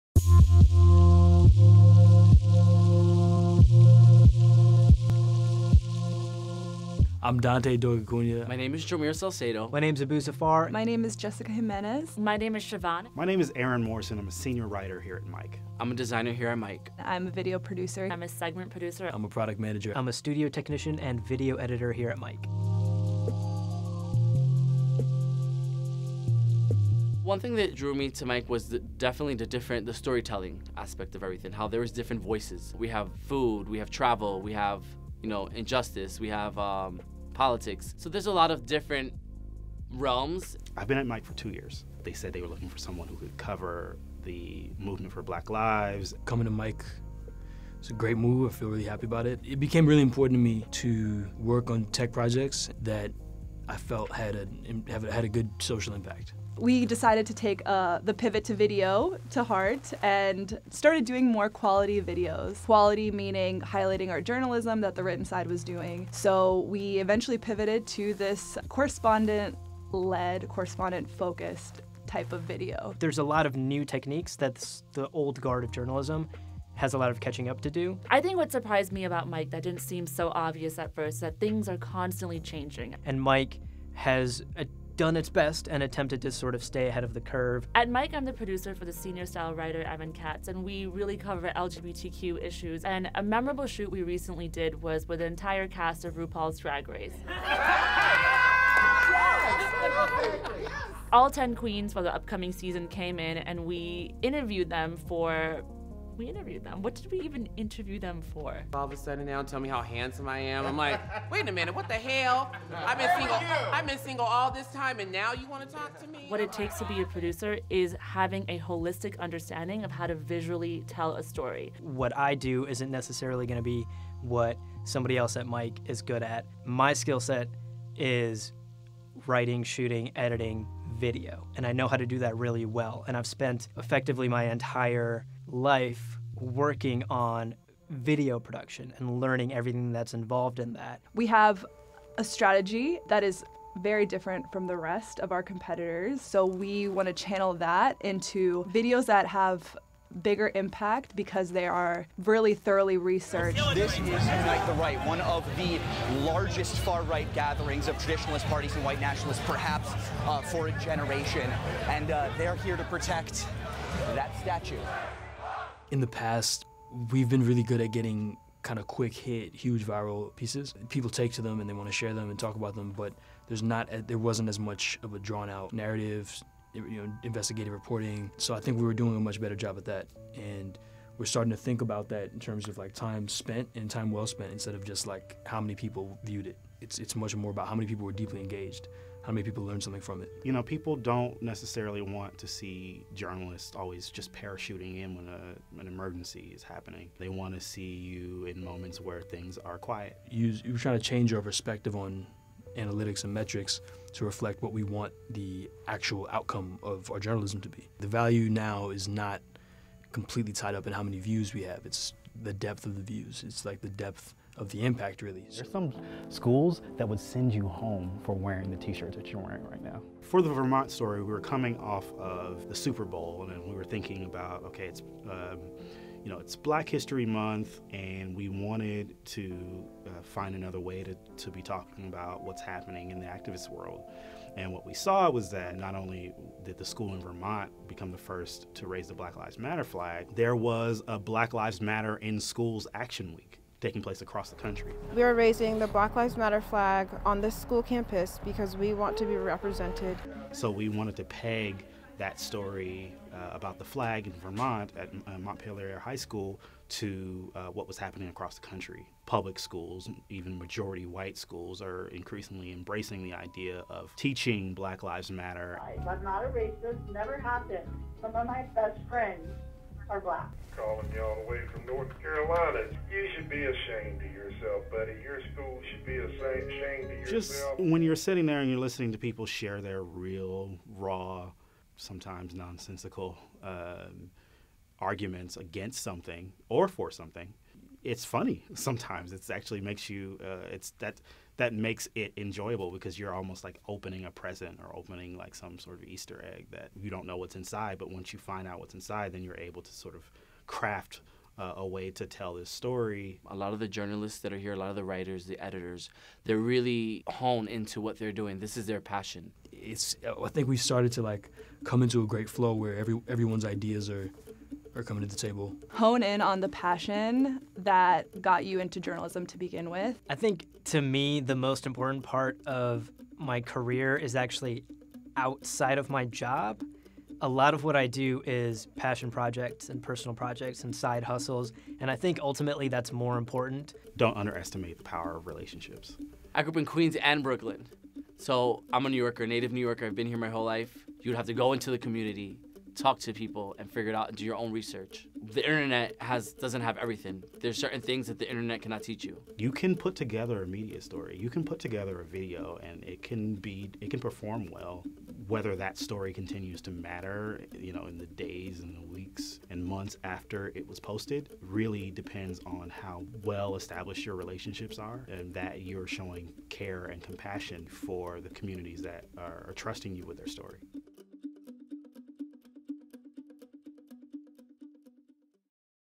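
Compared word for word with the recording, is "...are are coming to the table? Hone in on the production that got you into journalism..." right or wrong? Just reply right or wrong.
wrong.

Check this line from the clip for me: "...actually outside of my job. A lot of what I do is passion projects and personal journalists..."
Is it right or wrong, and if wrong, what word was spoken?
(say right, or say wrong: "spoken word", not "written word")
wrong: "projects", not "journalists".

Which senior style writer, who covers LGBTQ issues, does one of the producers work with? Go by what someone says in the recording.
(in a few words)
Evan Katz.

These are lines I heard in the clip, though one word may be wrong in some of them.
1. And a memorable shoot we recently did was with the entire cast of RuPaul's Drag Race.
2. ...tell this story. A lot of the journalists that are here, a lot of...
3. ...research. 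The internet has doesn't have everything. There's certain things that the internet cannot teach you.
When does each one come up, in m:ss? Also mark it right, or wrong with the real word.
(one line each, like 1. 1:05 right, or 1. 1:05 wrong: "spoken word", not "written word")
1. 1:32 right
2. 5:02 right
3. 5:44 right.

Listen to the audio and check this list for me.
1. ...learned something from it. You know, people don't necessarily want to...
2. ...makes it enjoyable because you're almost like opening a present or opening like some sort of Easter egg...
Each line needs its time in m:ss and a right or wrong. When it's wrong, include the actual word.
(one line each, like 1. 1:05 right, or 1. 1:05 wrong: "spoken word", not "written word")
1. 3:09 right
2. 4:51 right.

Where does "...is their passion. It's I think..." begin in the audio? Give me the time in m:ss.
5:08.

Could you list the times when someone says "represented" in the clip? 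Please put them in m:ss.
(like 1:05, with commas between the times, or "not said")
4:09.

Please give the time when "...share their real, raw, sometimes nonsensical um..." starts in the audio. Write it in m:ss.
4:39.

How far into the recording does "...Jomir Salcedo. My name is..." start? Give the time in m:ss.
0:08.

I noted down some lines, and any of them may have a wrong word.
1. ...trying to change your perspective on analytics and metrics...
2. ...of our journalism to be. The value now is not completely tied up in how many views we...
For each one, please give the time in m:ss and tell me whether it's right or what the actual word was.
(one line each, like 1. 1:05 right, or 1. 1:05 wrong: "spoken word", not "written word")
1. 3:20 right
2. 3:26 right.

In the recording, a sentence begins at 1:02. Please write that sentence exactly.
Quality meaning highlighting our journalism that the written side was doing.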